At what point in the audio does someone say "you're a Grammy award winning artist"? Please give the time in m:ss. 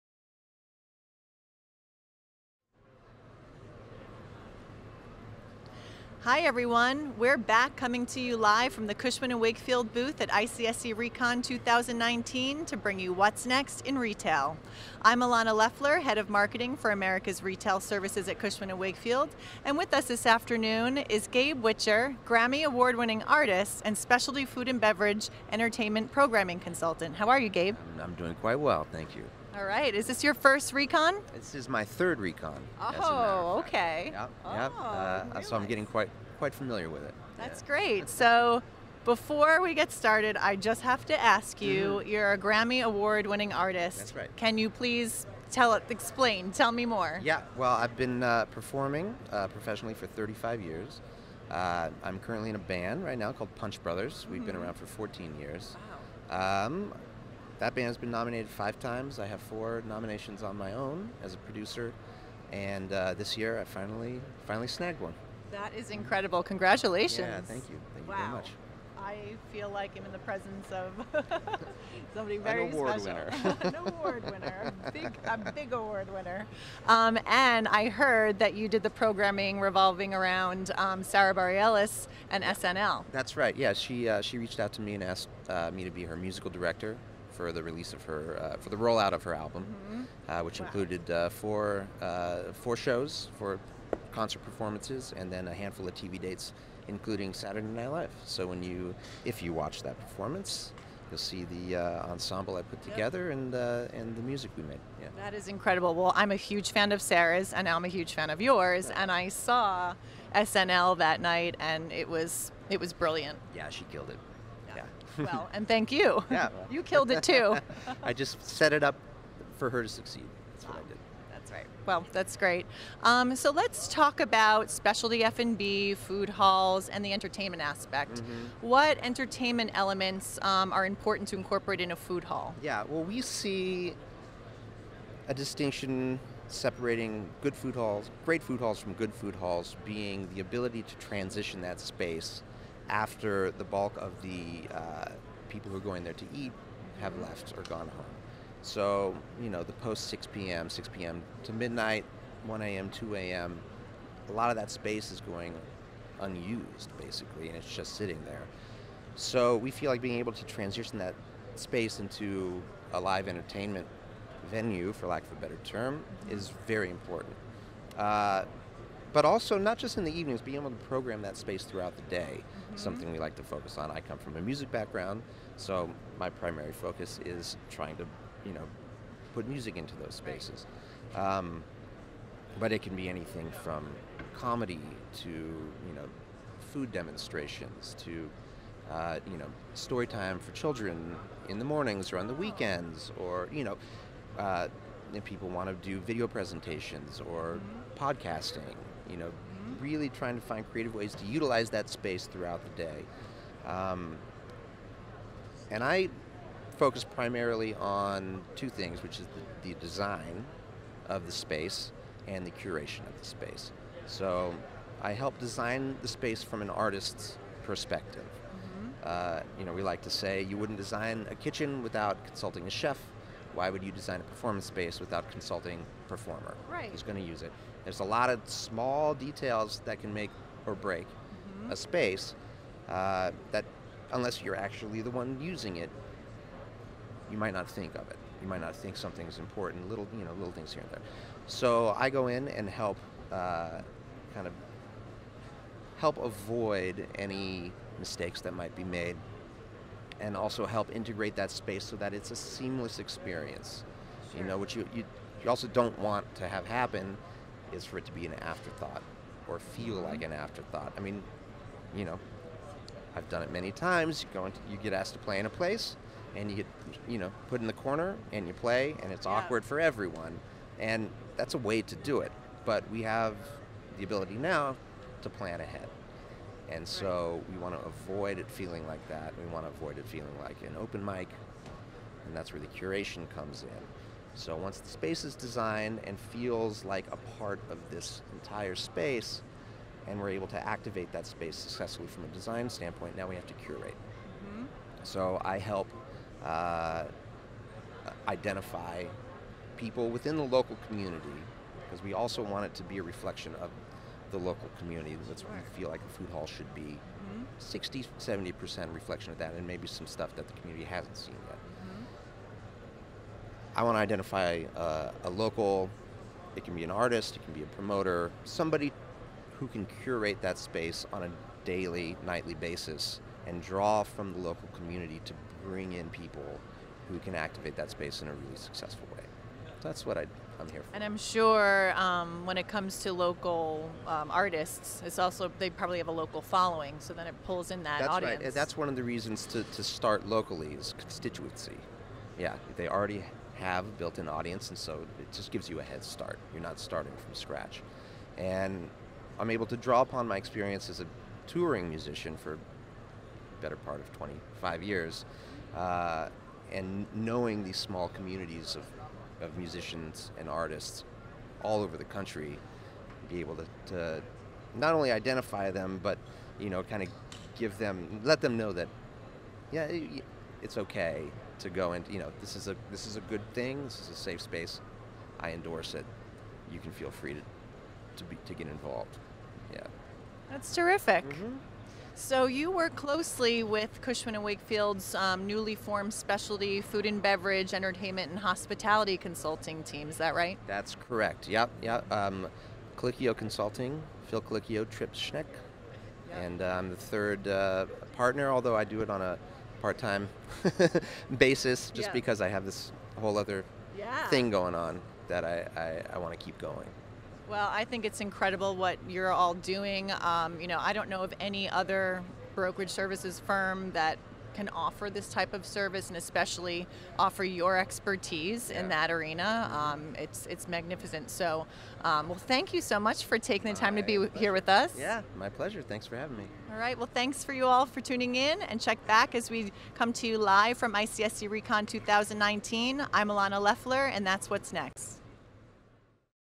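0:42.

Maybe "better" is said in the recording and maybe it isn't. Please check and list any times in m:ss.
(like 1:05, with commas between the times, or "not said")
2:45, 5:53.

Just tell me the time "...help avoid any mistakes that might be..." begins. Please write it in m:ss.
4:05.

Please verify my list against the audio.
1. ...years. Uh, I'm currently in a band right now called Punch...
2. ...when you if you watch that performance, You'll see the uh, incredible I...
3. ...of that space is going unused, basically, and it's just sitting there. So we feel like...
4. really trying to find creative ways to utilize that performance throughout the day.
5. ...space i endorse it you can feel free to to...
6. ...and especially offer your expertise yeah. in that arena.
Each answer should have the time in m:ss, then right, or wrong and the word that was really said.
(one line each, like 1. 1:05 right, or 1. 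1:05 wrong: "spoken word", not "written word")
1. 0:50 right
2. 1:38 wrong: "ensemble", not "incredible"
3. 2:34 right
4. 3:19 wrong: "space", not "performance"
5. 6:14 right
6. 6:56 right.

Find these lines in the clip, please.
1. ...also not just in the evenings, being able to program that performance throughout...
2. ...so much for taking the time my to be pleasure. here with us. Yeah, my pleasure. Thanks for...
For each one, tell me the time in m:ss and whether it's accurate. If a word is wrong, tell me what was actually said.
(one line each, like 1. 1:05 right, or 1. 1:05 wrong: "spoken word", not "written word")
1. 2:49 wrong: "space", not "performance"
2. 7:02 right.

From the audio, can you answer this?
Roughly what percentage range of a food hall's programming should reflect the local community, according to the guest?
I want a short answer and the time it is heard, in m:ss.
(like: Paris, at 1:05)
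60-70%, at 5:07.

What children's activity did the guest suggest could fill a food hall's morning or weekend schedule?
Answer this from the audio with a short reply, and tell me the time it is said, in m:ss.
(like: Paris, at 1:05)
story time, at 3:09.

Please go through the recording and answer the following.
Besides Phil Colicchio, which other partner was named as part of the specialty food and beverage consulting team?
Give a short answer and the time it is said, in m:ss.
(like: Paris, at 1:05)
Tripp Schneck, at 6:34.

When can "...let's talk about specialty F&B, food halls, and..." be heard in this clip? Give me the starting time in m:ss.
2:03.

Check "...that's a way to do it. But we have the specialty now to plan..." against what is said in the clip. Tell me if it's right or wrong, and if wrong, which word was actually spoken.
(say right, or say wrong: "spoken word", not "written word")
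wrong: "ability", not "specialty".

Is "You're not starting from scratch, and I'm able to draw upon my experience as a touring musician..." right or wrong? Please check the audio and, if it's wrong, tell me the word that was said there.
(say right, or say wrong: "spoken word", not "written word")
right.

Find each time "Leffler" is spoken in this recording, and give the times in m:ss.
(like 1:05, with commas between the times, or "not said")
0:15, 7:13.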